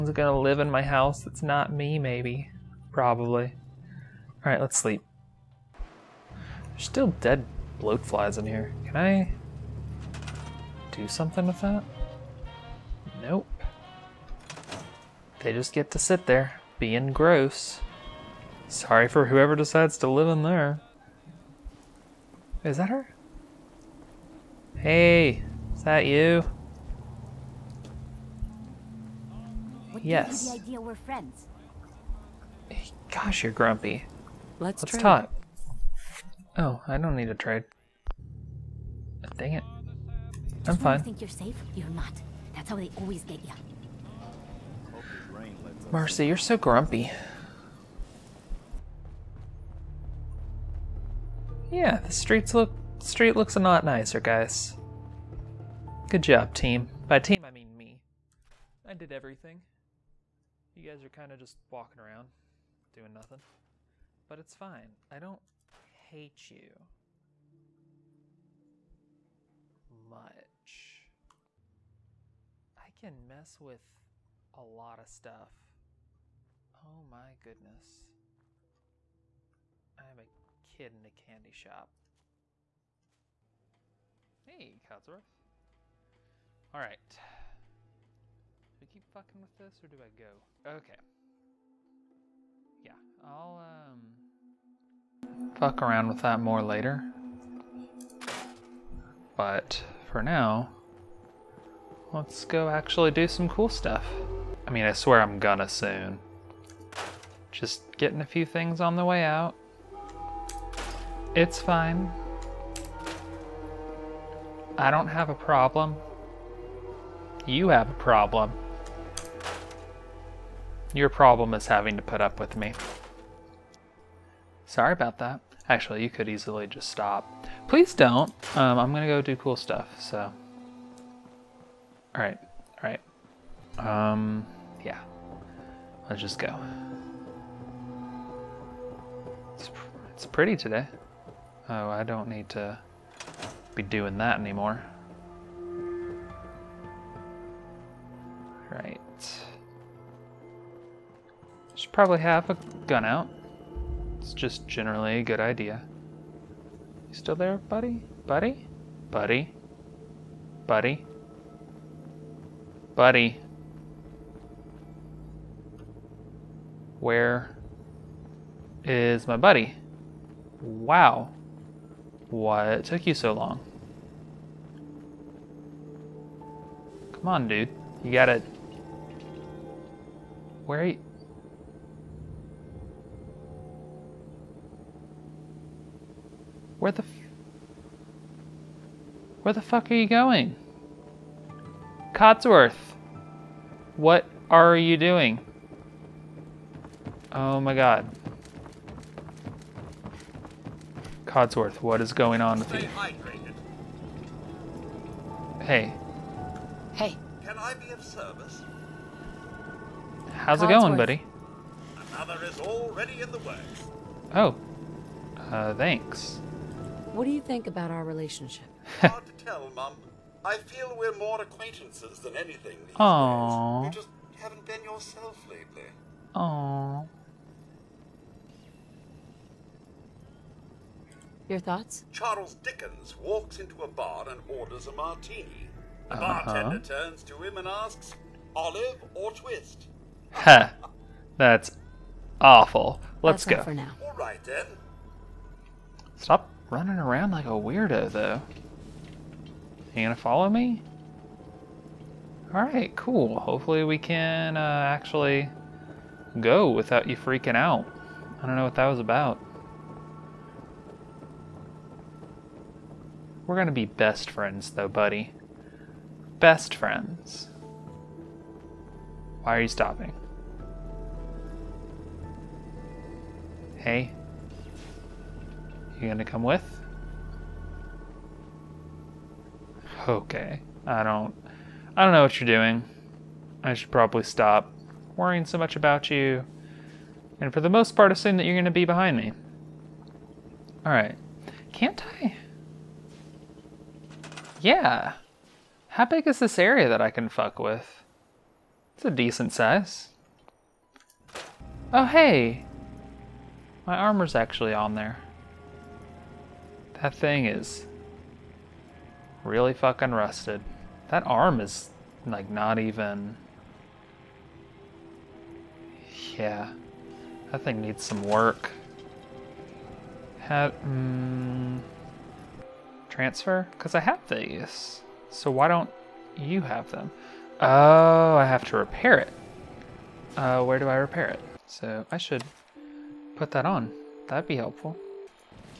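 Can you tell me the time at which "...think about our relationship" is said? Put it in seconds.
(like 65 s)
217 s.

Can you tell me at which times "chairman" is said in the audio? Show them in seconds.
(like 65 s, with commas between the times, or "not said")
not said.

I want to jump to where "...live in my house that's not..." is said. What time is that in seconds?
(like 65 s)
0 s.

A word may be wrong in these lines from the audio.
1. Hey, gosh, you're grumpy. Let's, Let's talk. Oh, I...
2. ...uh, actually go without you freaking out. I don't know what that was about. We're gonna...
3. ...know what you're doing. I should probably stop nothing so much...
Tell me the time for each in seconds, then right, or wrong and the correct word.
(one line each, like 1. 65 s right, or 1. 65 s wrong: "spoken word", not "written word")
1. 32 s right
2. 254 s right
3. 282 s wrong: "worrying", not "nothing".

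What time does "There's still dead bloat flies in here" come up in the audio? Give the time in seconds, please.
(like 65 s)
6 s.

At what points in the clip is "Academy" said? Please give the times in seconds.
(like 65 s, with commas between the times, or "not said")
not said.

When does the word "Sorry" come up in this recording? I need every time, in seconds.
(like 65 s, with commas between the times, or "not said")
18 s, 124 s.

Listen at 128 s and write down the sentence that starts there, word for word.
Um, I'm gonna go do cool stuff, so.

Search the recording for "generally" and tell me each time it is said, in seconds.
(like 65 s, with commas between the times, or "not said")
154 s.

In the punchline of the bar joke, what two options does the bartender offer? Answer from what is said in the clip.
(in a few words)
olive or twist.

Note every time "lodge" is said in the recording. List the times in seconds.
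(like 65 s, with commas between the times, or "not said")
not said.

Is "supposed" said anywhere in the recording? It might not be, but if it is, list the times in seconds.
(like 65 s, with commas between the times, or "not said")
not said.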